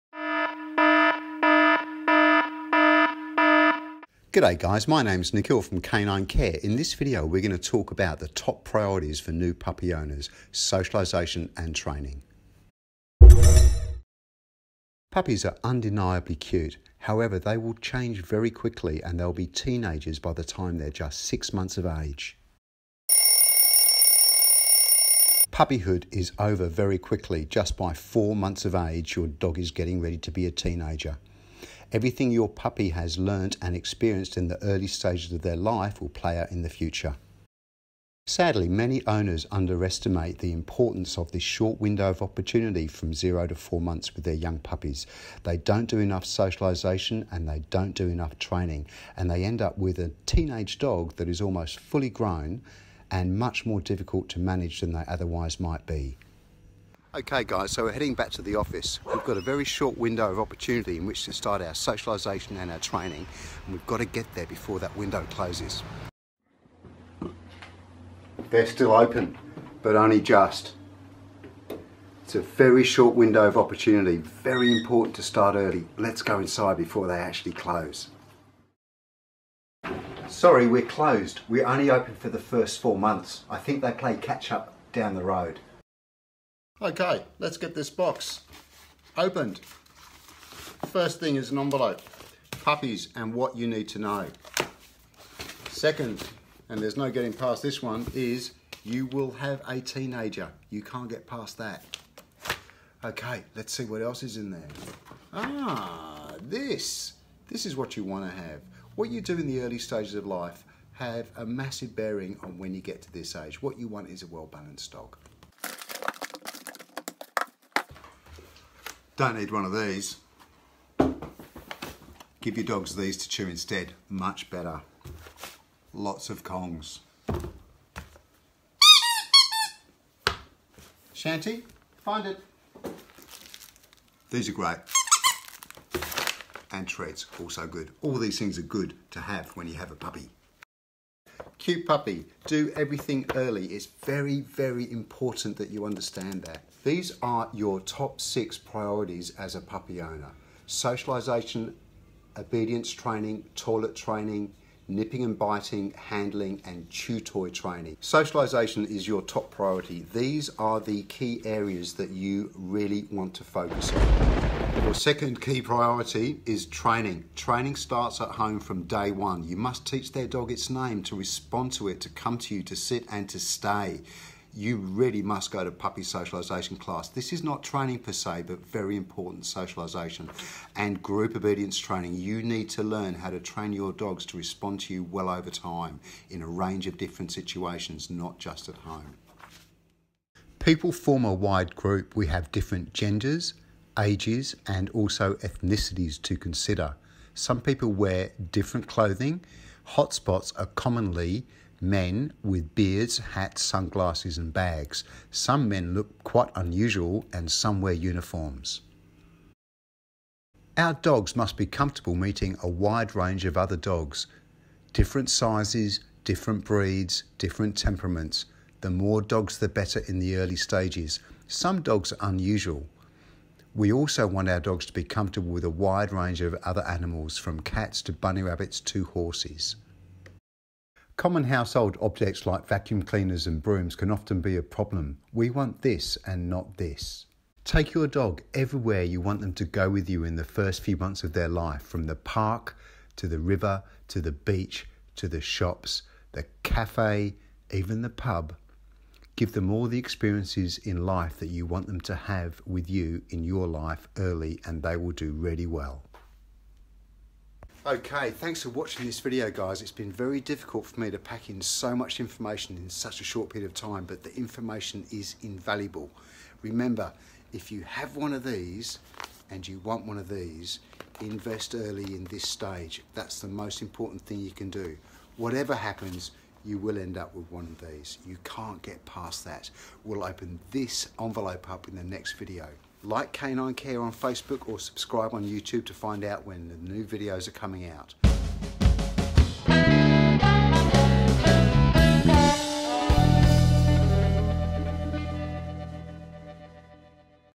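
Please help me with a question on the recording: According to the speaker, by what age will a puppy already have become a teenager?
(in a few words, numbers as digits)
6 months.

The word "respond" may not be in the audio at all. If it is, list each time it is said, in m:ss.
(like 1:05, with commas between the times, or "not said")
2:51, 3:04.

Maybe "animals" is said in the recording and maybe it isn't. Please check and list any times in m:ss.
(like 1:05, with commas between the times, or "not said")
3:46.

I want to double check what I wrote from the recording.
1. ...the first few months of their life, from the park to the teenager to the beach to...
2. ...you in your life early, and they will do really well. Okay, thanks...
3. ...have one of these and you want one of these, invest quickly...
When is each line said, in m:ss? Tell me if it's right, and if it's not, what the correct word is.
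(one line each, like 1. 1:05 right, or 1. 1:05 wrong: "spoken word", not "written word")
1. 4:00 wrong: "river", not "teenager"
2. 4:12 right
3. 4:27 wrong: "early", not "quickly".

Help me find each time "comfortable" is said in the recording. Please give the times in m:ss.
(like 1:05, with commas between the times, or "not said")
3:31, 3:45.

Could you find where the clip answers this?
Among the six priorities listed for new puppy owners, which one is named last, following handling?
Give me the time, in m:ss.
2:36.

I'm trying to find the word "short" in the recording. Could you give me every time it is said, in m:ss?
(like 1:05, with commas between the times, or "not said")
0:41, 0:59, 1:12, 4:23.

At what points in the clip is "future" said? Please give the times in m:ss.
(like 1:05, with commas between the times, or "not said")
0:36.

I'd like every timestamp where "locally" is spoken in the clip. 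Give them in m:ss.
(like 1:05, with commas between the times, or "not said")
not said.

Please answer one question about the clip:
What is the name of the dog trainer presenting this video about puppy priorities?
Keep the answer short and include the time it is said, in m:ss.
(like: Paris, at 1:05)
Nikhil, at 0:05.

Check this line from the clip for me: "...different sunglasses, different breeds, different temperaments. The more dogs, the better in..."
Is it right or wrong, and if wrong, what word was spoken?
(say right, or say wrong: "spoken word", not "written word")
wrong: "sizes", not "sunglasses".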